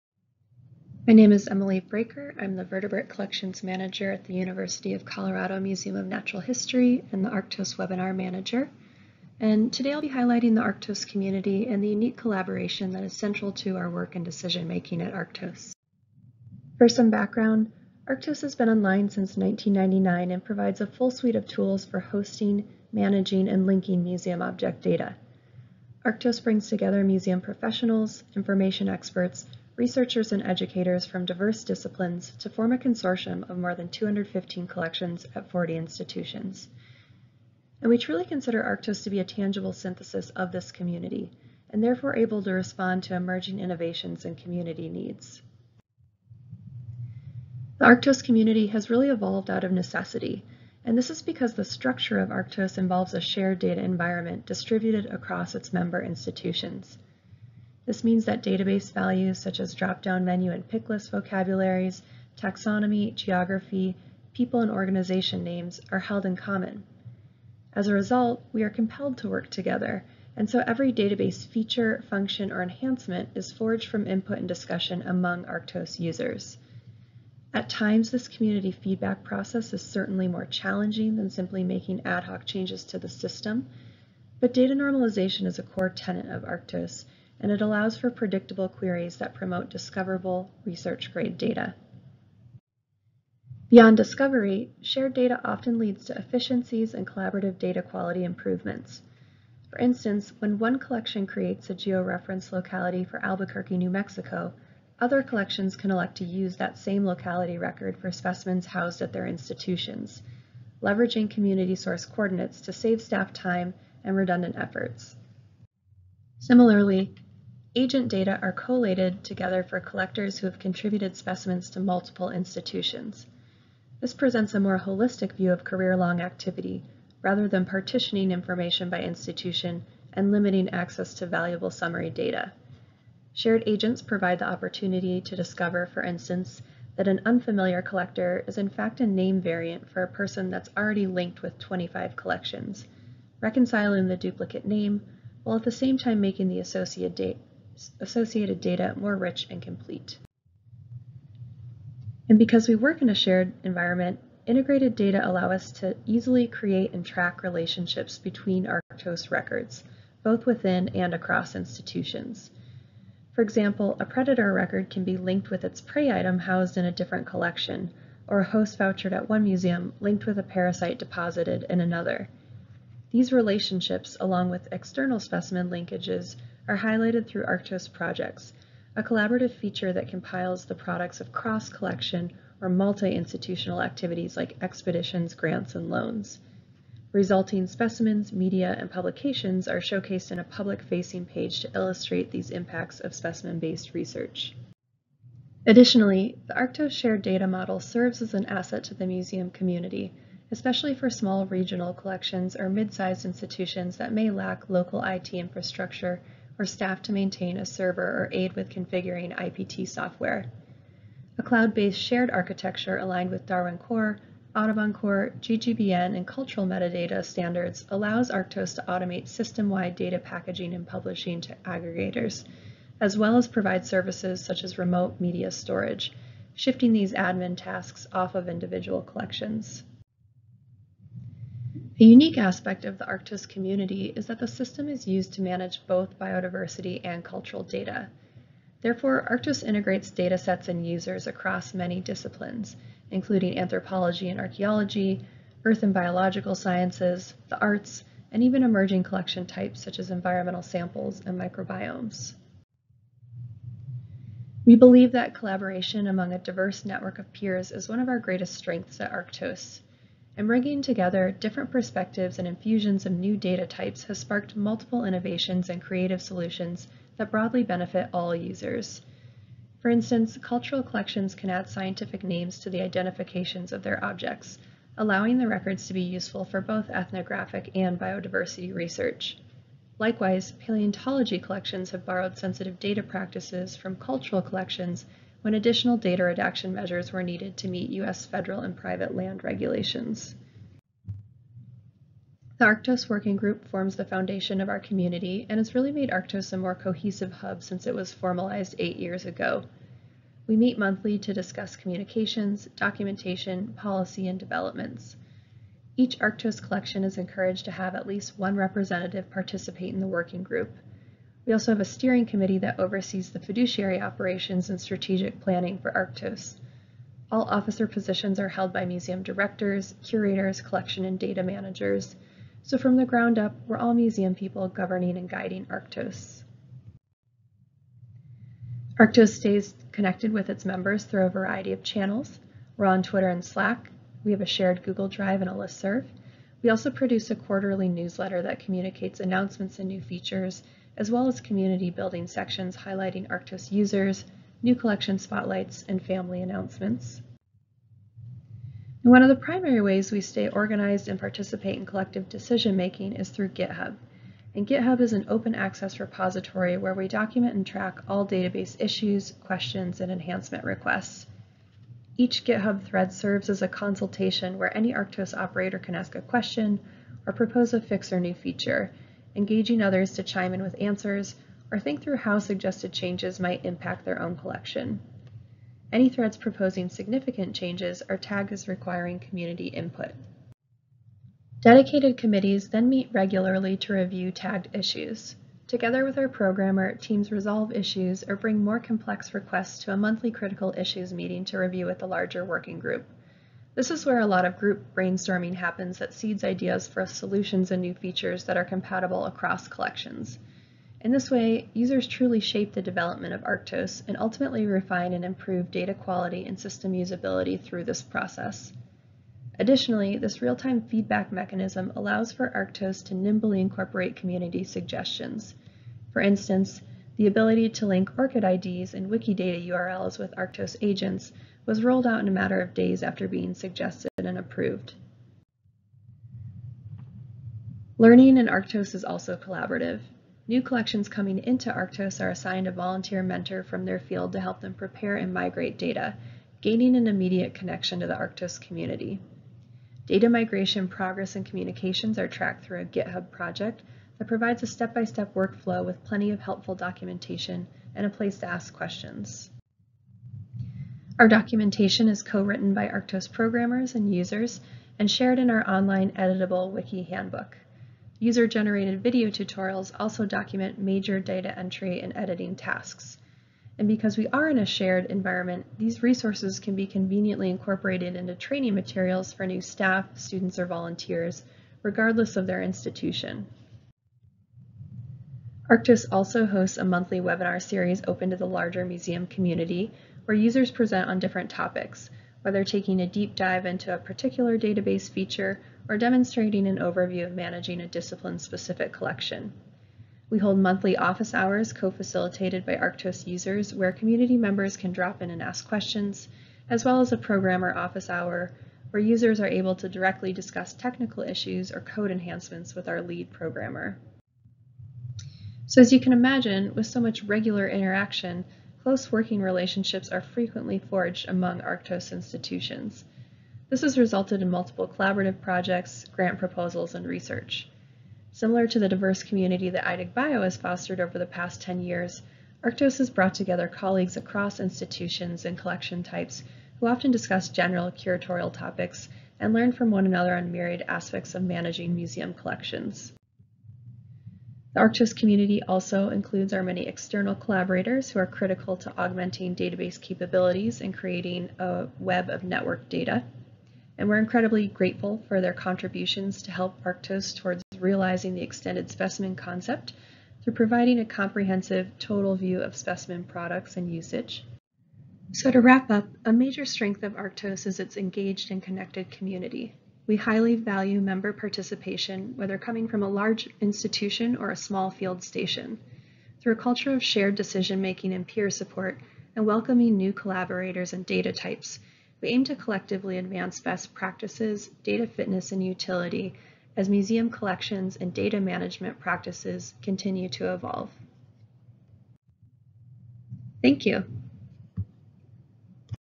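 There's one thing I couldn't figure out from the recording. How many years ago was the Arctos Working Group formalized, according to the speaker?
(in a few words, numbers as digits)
8.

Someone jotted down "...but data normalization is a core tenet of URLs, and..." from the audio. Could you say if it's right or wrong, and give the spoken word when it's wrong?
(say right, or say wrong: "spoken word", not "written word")
wrong: "Arctos", not "URLs".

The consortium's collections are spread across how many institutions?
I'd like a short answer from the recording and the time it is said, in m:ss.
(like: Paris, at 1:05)
40, at 0:35.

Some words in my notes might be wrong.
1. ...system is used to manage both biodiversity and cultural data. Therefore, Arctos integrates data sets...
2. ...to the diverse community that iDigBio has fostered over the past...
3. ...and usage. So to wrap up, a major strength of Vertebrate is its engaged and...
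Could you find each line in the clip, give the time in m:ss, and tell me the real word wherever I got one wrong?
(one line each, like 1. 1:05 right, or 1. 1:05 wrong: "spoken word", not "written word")
1. 3:54 right
2. 8:38 right
3. 9:13 wrong: "Arctos", not "Vertebrate".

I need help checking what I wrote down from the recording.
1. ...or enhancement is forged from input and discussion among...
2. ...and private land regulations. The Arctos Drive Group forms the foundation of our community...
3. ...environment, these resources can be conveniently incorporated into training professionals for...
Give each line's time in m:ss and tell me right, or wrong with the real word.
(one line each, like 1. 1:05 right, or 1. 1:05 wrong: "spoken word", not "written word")
1. 1:12 right
2. 4:48 wrong: "Working", not "Drive"
3. 7:45 wrong: "materials", not "professionals".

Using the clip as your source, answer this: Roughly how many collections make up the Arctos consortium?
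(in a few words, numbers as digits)
more than 215.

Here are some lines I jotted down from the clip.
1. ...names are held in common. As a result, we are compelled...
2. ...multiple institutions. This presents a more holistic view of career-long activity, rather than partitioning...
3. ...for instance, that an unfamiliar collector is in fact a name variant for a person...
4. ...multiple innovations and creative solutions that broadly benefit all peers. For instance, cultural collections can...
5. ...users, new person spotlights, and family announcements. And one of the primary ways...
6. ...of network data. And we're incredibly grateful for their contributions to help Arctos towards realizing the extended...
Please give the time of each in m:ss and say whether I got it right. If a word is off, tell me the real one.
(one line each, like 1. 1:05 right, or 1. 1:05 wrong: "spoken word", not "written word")
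1. 1:05 right
2. 2:01 right
3. 2:15 right
4. 4:24 wrong: "users", not "peers"
5. 5:43 wrong: "collection", not "person"
6. 9:02 right.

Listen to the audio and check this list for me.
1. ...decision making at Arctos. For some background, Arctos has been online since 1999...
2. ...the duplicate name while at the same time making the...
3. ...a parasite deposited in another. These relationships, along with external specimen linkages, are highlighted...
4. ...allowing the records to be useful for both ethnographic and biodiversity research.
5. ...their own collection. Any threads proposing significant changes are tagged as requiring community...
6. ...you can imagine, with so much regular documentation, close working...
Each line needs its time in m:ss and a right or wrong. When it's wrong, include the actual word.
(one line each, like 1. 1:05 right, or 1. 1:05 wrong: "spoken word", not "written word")
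1. 0:14 right
2. 2:24 right
3. 2:50 right
4. 4:34 right
5. 6:14 right
6. 8:25 wrong: "interaction", not "documentation".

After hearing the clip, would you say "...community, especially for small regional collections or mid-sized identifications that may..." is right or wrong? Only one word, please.
wrong.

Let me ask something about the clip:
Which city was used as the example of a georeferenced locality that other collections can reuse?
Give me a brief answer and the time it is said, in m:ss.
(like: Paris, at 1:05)
Albuquerque, New Mexico, at 1:43.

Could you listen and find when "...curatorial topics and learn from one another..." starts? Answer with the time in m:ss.
8:47.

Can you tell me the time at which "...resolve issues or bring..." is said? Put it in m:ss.
6:27.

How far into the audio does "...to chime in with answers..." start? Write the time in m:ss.
6:10.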